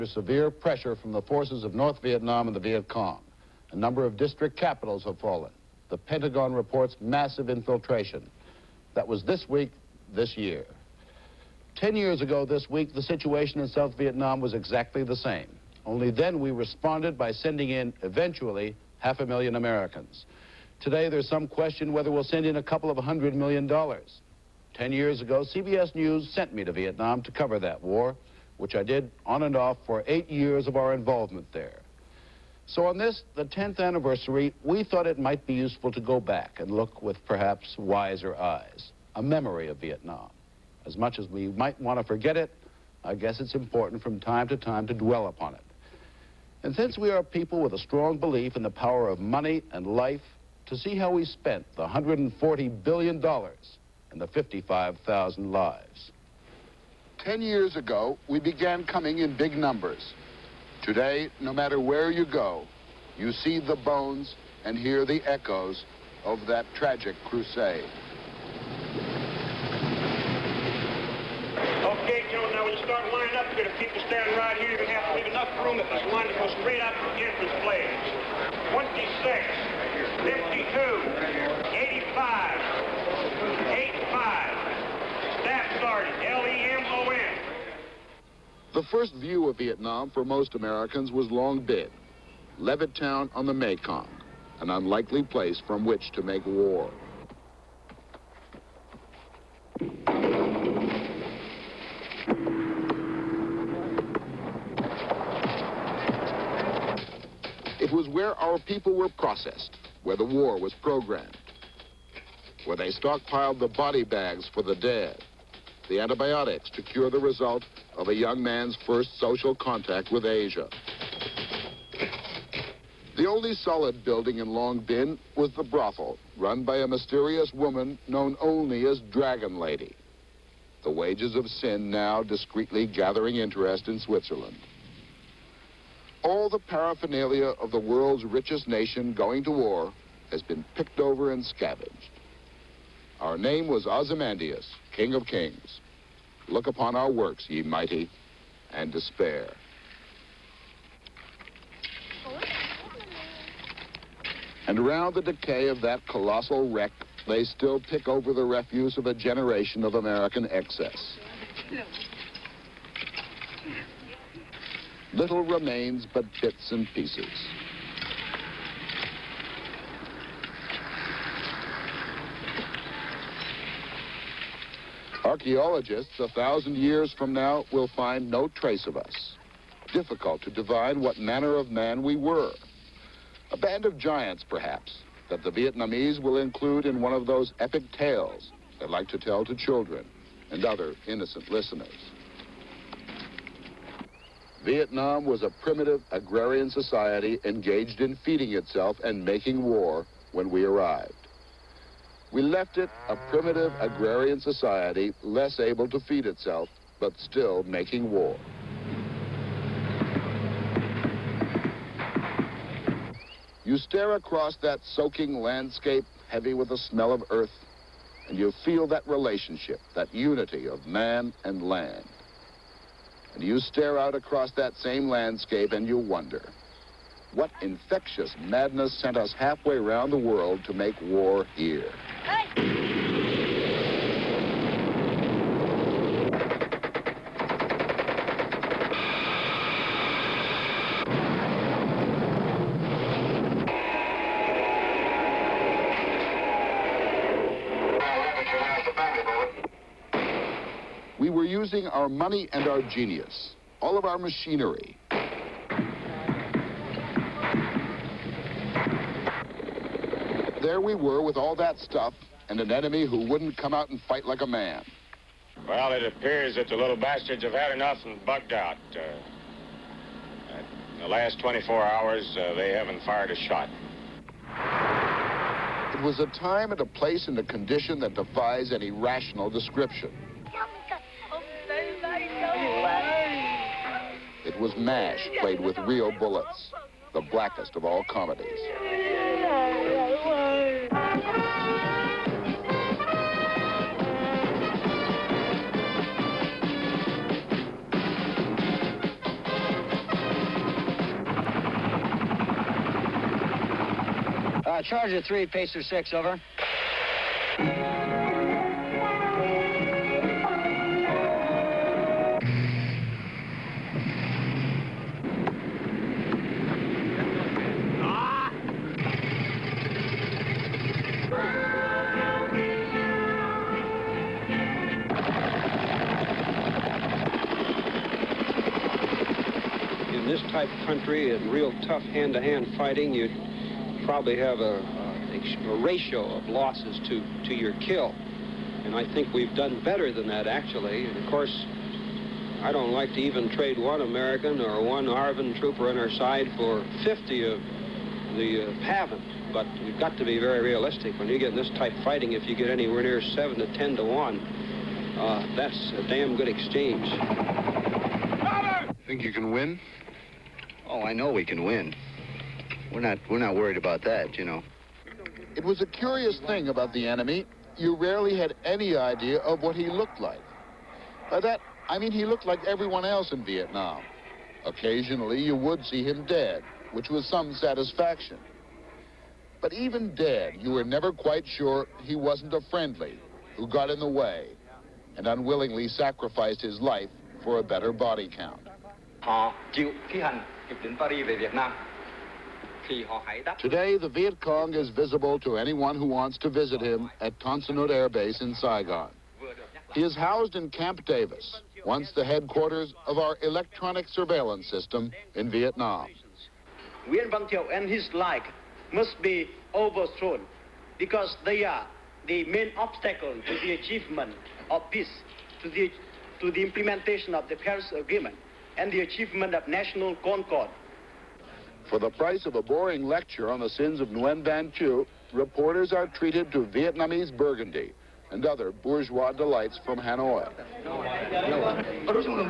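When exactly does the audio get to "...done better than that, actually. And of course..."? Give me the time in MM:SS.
05:39.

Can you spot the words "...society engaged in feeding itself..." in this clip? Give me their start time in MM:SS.
03:16.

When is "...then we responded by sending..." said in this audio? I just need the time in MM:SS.
00:16.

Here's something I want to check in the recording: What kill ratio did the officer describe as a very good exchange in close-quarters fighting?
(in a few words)
7 to 10 to 1.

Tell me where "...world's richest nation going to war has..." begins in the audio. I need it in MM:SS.
02:17.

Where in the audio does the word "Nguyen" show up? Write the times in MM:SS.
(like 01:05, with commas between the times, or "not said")
06:47, 07:04.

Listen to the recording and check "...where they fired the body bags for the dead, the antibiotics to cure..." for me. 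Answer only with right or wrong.
wrong.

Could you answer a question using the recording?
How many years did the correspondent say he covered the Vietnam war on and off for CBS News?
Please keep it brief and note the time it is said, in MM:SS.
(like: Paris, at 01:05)
8, at 00:30.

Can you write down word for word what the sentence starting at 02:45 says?
Little remains but bits and pieces.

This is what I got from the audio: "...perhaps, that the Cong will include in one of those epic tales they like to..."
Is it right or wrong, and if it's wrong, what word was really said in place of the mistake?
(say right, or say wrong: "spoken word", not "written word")
wrong: "Vietnamese", not "Cong".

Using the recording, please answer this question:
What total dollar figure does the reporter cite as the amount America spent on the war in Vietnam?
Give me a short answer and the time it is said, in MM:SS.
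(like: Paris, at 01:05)
$140 billion, at 00:51.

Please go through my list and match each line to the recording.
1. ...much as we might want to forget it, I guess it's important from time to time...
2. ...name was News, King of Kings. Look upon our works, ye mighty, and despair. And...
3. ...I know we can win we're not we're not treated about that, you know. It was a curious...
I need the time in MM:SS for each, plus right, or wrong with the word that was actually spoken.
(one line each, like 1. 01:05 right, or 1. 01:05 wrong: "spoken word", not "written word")
1. 00:40 right
2. 02:23 wrong: "Ozymandias", not "News"
3. 06:01 wrong: "worried", not "treated".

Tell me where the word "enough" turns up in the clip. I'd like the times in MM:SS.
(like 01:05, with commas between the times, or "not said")
01:15, 04:27.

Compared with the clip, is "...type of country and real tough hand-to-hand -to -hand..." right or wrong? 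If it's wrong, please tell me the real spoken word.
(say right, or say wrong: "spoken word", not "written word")
right.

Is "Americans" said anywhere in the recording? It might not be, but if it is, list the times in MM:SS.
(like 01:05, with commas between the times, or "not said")
00:19, 01:30, 02:39, 05:43.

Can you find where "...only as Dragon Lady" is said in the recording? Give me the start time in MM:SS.
02:08.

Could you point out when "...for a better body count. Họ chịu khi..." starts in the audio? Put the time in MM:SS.
06:27.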